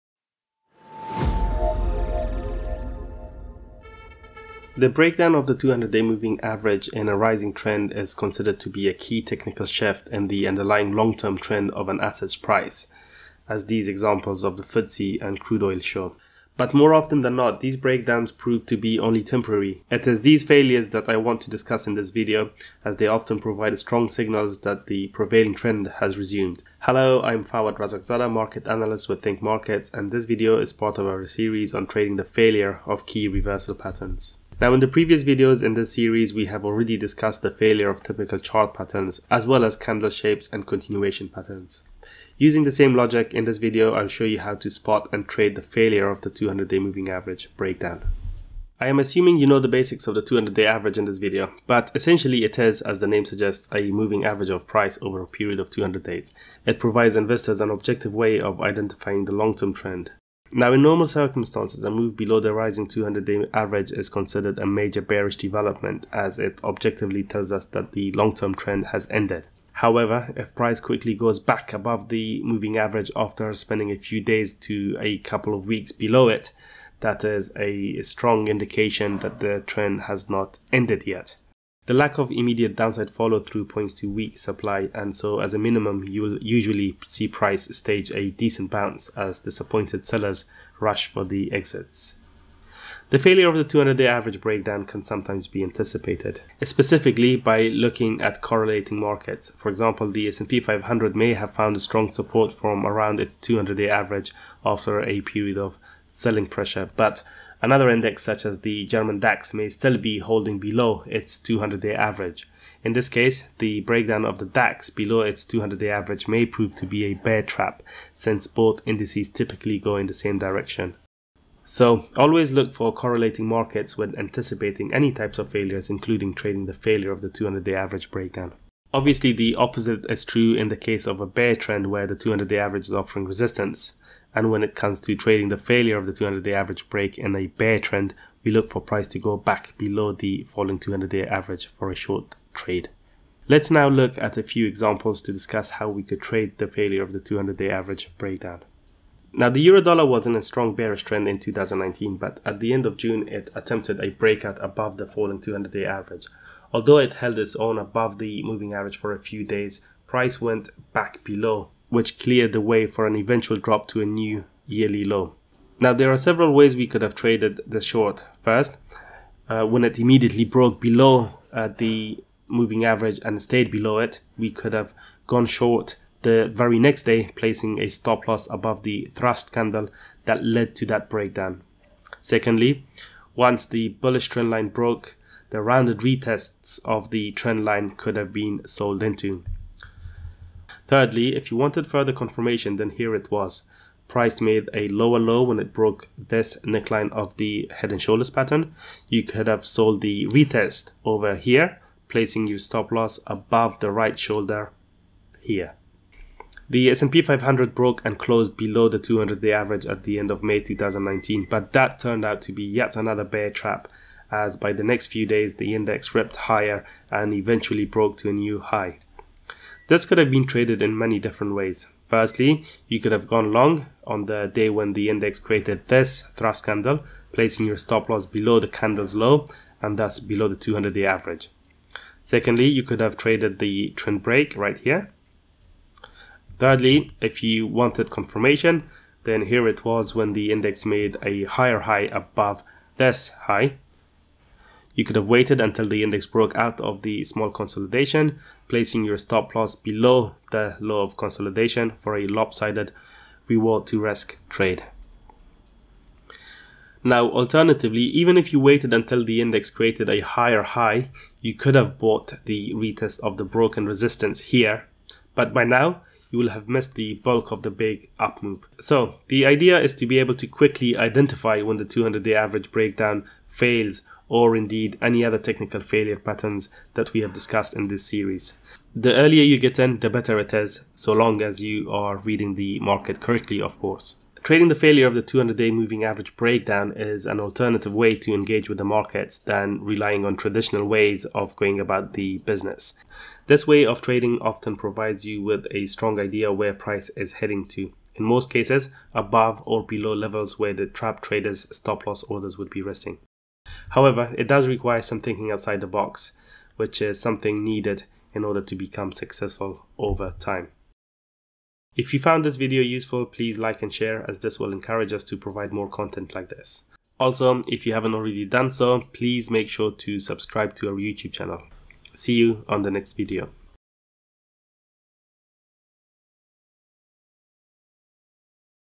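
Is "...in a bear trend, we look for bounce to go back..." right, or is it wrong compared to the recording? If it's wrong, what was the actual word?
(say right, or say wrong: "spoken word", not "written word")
wrong: "price", not "bounce".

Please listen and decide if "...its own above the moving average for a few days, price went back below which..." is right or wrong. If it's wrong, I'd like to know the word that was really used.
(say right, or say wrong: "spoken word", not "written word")
right.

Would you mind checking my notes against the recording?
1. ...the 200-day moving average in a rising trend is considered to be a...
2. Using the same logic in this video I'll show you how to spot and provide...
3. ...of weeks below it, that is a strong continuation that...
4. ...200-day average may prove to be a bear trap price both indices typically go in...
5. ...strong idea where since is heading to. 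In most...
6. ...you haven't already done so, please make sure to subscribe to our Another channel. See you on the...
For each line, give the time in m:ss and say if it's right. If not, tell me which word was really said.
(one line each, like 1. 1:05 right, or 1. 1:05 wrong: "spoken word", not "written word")
1. 0:05 right
2. 0:42 wrong: "trade", not "provide"
3. 1:15 wrong: "indication", not "continuation"
4. 1:55 wrong: "since", not "price"
5. 4:55 wrong: "price", not "since"
6. 5:17 wrong: "YouTube", not "Another".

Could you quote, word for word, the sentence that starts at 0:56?
It provides investors an objective way of identifying the long term trend.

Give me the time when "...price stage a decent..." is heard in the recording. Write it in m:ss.
1:27.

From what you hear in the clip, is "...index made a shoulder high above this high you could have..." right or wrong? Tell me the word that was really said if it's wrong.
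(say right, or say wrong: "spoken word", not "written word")
wrong: "higher", not "shoulder".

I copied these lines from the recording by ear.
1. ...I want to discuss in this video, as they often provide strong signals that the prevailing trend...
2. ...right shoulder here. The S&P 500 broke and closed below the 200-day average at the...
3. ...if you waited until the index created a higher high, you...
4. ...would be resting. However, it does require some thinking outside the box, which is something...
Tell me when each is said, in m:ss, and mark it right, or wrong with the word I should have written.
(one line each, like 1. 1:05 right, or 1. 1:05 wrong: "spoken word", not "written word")
1. 0:21 right
2. 3:23 right
3. 4:18 right
4. 5:02 right.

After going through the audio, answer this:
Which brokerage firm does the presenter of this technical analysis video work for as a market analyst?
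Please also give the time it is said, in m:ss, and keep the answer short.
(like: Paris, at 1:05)
Think Markets, at 0:29.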